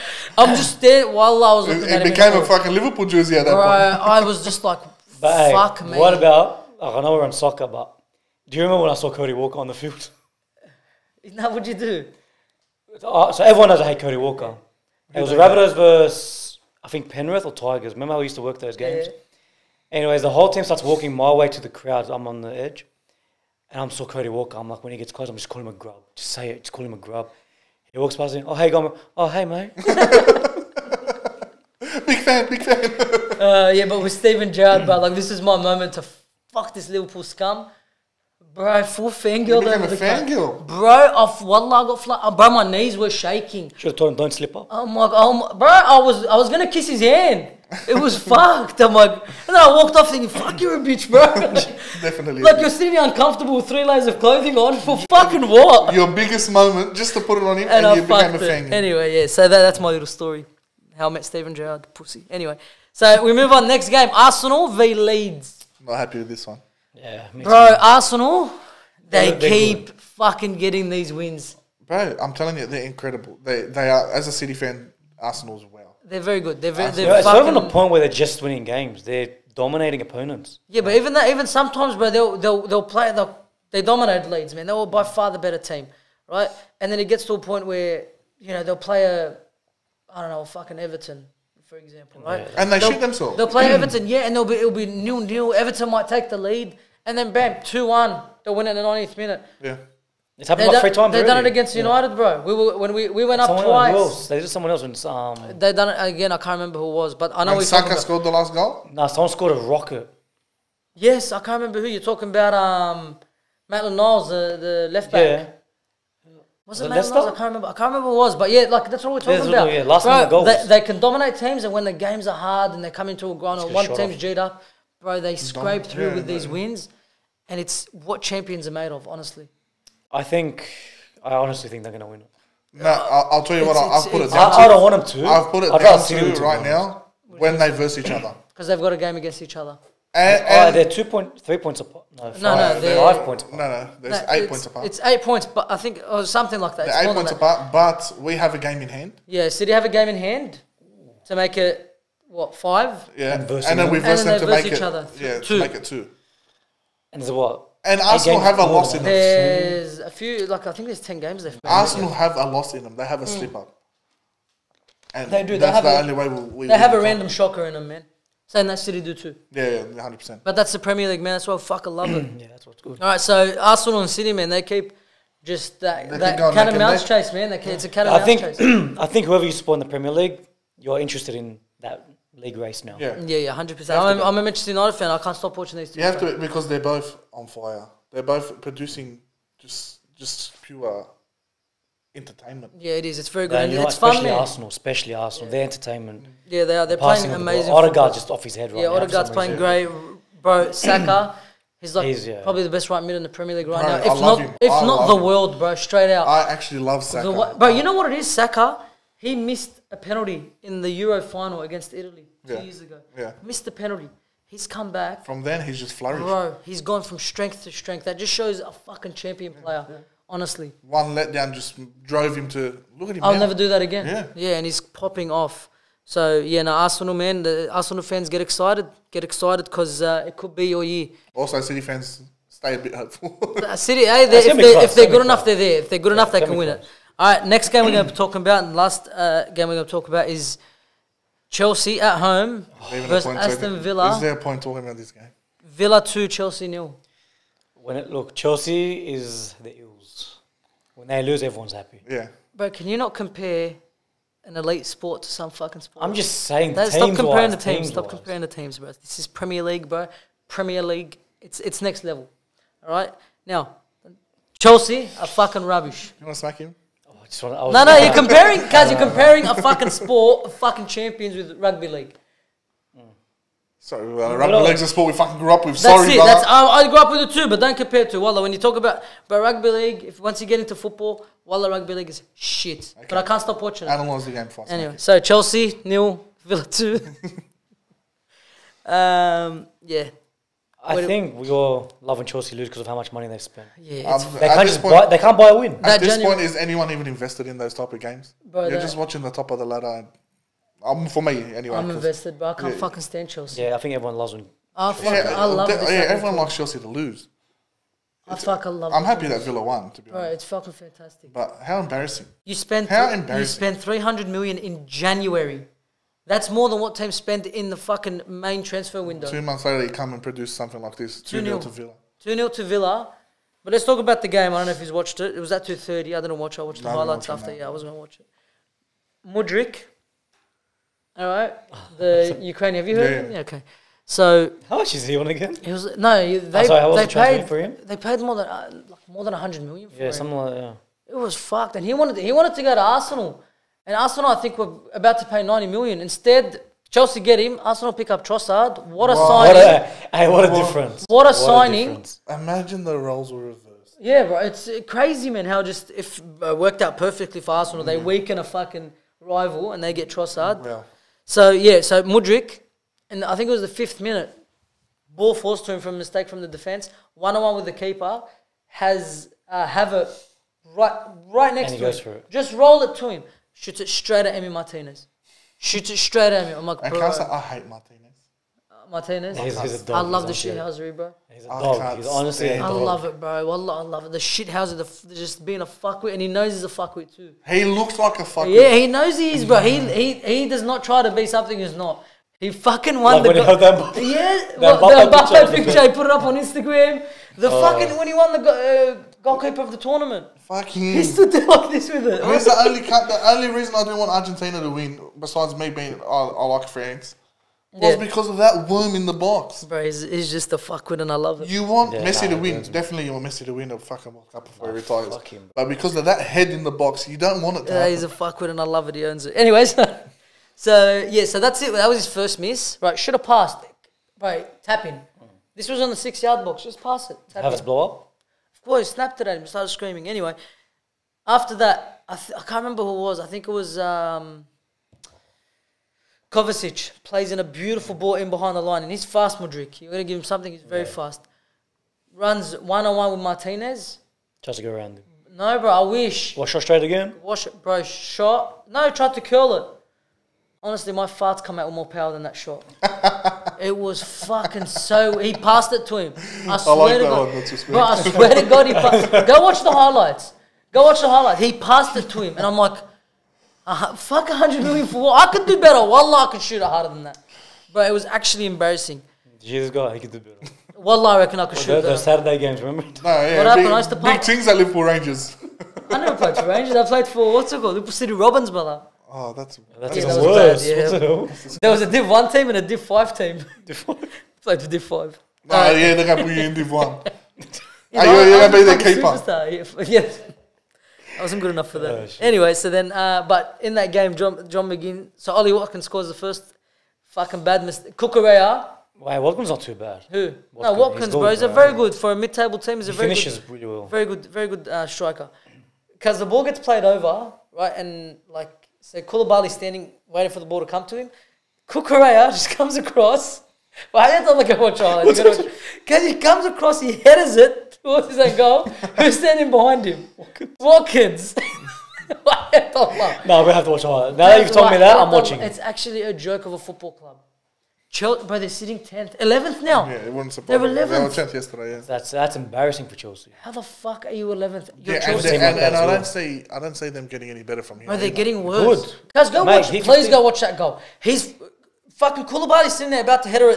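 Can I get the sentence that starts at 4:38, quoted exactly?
When you talk about, about rugby league, if once you get into football, Walla rugby league is shit.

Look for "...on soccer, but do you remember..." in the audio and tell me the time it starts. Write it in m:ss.
0:07.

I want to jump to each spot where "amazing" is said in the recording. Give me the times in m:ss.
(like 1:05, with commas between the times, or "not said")
3:17.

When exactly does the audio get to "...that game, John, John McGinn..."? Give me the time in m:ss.
8:13.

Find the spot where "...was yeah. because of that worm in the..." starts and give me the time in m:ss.
6:47.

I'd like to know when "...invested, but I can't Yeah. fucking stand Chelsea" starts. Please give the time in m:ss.
5:01.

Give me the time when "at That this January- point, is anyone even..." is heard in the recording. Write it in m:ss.
4:55.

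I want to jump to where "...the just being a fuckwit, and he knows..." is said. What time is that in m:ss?
6:25.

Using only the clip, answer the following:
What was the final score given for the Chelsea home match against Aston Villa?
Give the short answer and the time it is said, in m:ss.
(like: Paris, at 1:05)
Villa 2, Chelsea 0, at 4:05.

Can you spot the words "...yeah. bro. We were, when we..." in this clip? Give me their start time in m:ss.
1:42.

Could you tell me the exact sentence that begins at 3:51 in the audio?
Also, City fans stay a bit hopeful.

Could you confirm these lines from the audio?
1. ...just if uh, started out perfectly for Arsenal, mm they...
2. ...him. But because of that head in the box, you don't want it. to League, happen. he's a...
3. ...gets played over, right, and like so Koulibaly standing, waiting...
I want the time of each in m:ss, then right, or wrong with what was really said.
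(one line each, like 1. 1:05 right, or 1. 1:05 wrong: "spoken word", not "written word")
1. 5:55 wrong: "worked", not "started"
2. 6:55 wrong: "Yeah", not "League"
3. 8:26 right.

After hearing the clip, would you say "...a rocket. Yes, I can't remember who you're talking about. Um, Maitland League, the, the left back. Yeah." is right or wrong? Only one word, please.
wrong.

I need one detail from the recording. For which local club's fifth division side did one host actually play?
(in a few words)
Liverpool City Robins.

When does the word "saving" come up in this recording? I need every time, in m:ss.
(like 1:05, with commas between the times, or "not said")
not said.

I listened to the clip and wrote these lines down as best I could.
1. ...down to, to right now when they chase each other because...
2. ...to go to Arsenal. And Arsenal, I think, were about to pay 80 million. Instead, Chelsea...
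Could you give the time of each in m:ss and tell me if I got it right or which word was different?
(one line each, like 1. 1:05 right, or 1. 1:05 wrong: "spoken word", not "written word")
1. 2:15 wrong: "verse", not "chase"
2. 5:42 wrong: "90", not "80".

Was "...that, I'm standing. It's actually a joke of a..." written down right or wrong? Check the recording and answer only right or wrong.
wrong.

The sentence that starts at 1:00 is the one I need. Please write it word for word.
How I met Steven Gerrard, pussy.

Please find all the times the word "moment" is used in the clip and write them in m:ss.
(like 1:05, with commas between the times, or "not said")
0:35, 0:56.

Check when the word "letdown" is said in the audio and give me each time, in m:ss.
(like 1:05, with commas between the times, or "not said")
3:41.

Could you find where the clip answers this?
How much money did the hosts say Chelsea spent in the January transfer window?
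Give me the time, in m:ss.
5:13.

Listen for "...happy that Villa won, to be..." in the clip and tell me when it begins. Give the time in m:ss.
5:09.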